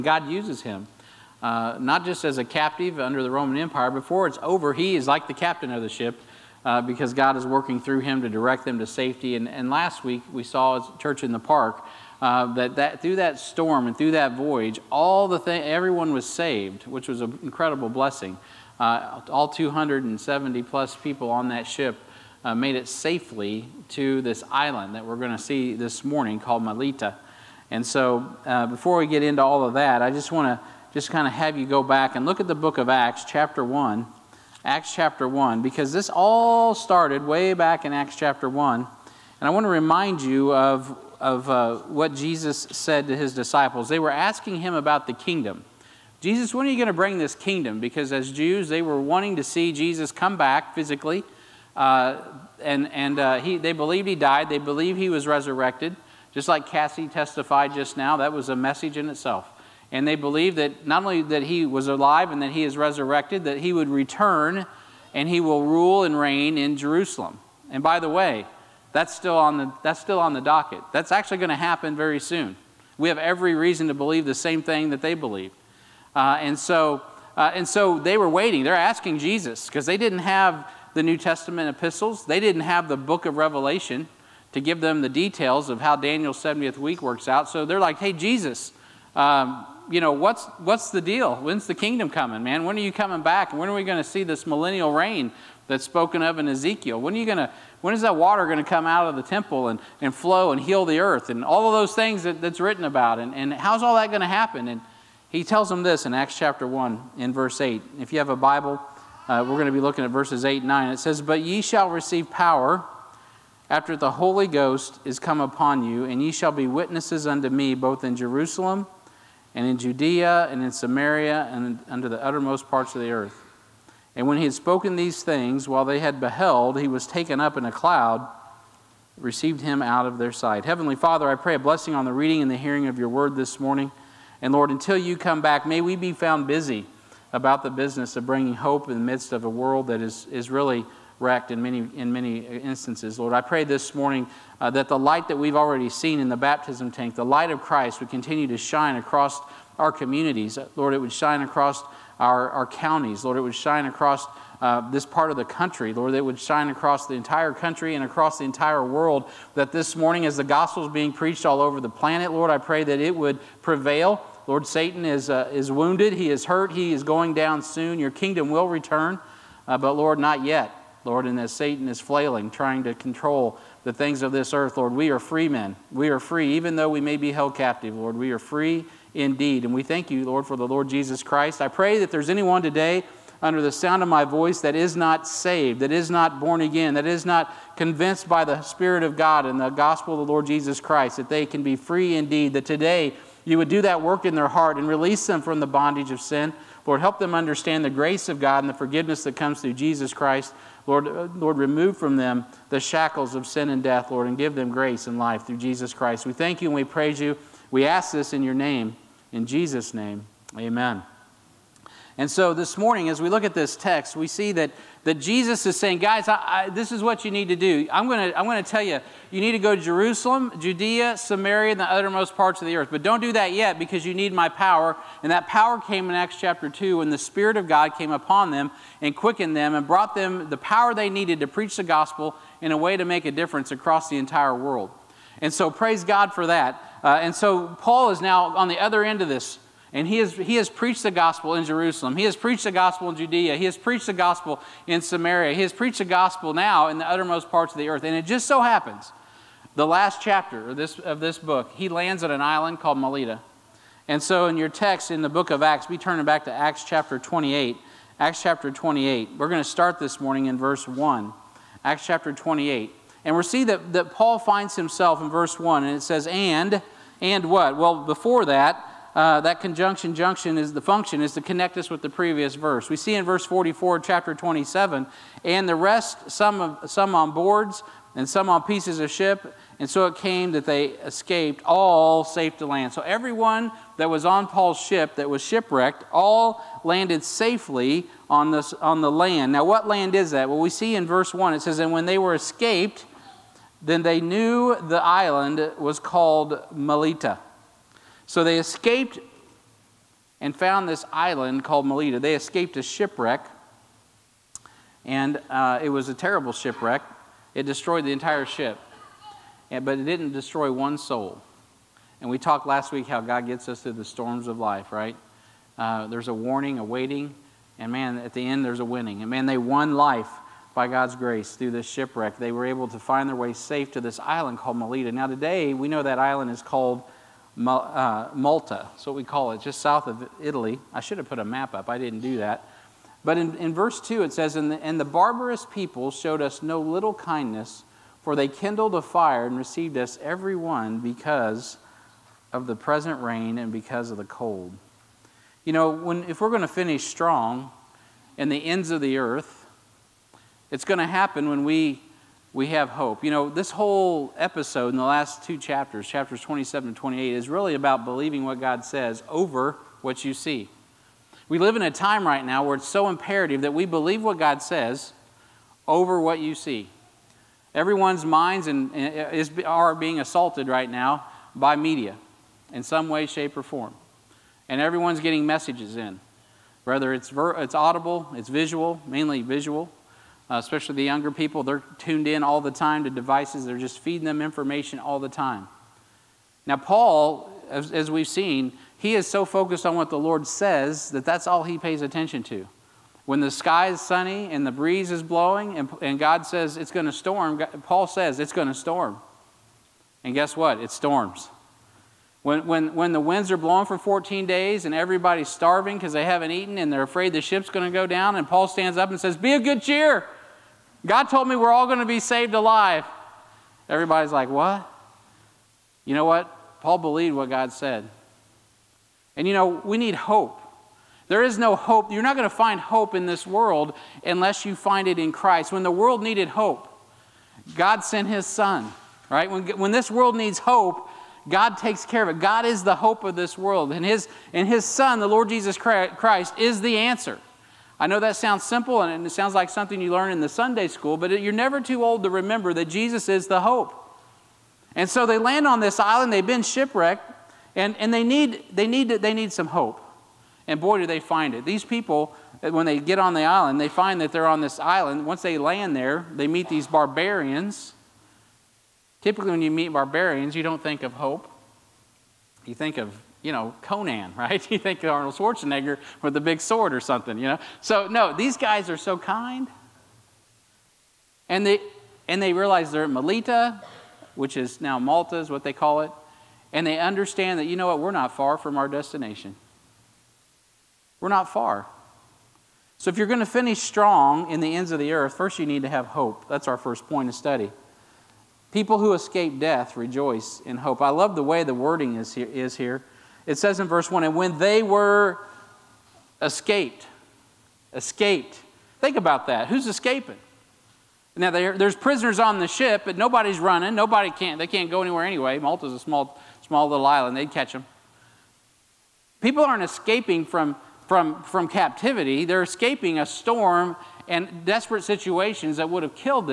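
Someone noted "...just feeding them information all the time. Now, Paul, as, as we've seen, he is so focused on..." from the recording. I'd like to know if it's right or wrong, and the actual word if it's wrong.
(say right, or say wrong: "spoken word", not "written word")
right.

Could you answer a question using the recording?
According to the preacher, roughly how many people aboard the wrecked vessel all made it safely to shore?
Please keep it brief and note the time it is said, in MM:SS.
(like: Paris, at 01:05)
270 plus, at 00:19.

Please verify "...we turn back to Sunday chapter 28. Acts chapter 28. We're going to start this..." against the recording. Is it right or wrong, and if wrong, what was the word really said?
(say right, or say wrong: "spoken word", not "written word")
wrong: "Acts", not "Sunday".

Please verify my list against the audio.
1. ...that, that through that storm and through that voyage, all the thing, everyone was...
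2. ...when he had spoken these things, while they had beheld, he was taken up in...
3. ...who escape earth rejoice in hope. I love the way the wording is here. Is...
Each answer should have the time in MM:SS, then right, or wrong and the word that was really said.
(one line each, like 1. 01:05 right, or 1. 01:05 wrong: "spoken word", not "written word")
1. 00:12 right
2. 02:04 right
3. 08:08 wrong: "death", not "earth".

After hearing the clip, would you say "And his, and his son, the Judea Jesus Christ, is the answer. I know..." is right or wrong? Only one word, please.
wrong.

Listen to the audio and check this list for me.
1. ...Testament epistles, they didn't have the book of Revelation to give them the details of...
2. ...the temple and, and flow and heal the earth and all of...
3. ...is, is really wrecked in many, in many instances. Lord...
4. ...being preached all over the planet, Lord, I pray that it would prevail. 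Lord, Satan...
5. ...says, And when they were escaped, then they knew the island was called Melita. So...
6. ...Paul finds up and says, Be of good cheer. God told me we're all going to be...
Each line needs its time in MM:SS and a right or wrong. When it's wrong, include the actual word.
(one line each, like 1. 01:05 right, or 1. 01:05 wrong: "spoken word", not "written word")
1. 01:21 right
2. 01:39 right
3. 02:20 right
4. 02:40 right
5. 04:51 right
6. 06:48 wrong: "stands", not "finds".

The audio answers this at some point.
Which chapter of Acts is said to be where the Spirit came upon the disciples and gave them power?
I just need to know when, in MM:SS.
03:46.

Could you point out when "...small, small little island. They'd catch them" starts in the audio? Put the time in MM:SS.
08:25.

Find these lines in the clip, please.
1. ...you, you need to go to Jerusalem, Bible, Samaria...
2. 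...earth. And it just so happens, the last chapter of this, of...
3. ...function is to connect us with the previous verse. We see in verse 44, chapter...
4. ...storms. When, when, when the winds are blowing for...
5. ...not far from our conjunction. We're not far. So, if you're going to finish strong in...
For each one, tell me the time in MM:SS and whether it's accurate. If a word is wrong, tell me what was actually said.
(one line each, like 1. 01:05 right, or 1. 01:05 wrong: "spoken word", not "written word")
1. 03:38 wrong: "Judea", not "Bible"
2. 04:07 right
3. 04:30 right
4. 06:40 right
5. 07:58 wrong: "destination", not "conjunction".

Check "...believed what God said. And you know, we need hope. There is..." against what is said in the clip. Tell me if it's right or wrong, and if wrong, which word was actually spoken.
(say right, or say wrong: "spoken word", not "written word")
right.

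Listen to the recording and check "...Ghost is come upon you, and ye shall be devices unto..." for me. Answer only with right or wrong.
wrong.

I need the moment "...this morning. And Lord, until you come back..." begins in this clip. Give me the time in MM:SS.
02:13.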